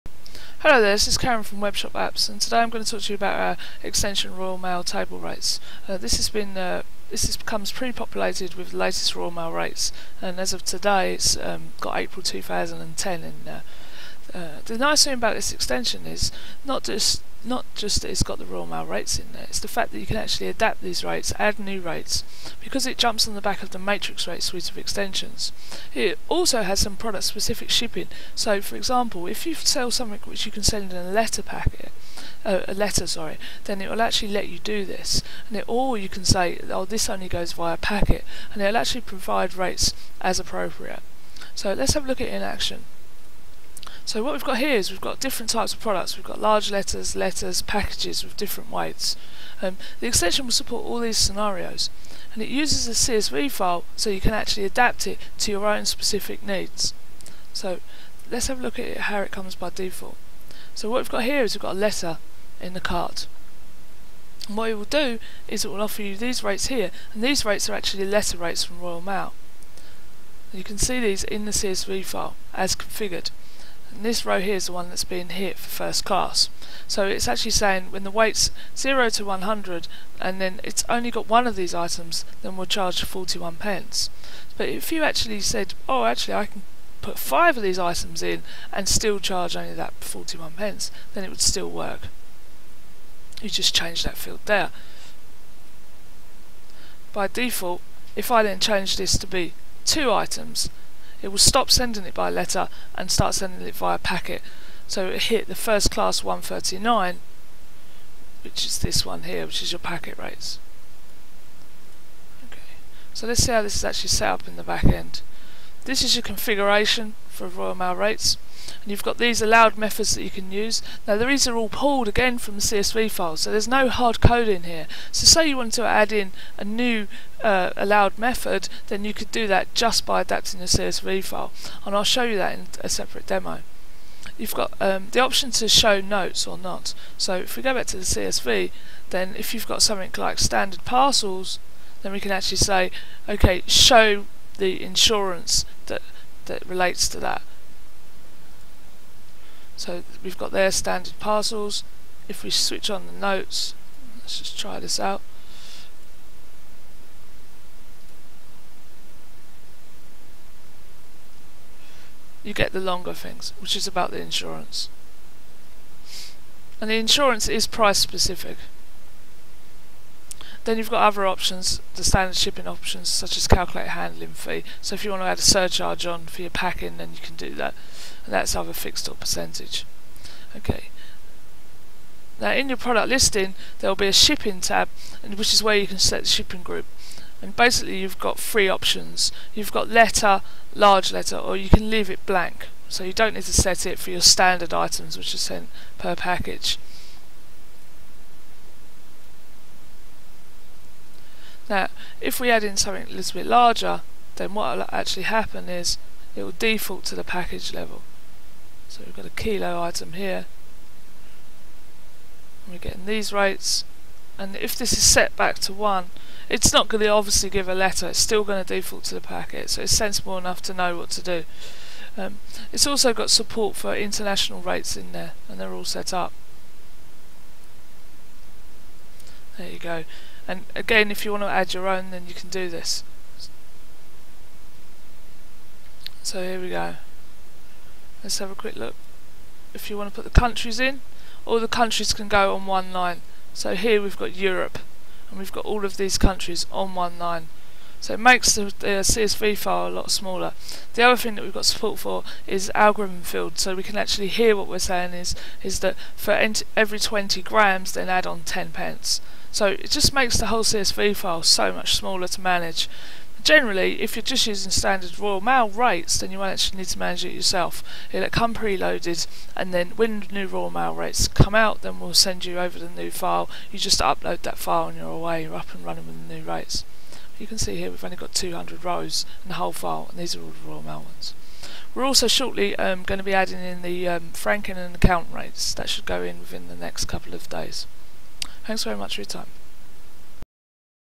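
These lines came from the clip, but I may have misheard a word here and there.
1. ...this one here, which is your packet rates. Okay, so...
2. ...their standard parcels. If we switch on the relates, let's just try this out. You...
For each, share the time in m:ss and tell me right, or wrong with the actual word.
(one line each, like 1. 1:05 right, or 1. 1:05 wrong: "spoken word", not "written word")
1. 1:48 right
2. 2:30 wrong: "notes", not "relates".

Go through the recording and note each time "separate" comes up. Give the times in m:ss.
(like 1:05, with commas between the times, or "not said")
2:12.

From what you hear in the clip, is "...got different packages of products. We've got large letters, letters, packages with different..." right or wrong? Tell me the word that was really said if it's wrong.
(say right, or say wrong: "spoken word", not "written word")
wrong: "types", not "packages".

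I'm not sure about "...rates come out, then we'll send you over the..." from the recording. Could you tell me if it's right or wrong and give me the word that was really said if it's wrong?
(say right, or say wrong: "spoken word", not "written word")
right.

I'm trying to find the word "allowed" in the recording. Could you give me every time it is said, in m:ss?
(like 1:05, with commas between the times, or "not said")
1:59, 2:07.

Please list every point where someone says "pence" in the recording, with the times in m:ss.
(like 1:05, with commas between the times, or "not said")
1:23, 1:30, 4:18.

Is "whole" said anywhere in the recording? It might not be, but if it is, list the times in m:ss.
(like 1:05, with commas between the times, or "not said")
4:20, 4:39.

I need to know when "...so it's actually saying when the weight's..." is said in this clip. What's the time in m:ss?
1:16.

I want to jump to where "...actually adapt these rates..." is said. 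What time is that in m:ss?
0:20.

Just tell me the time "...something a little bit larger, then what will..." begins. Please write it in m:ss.
3:22.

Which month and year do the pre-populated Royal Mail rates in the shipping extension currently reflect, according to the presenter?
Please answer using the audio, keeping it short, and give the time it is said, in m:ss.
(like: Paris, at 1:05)
April 2010, at 0:11.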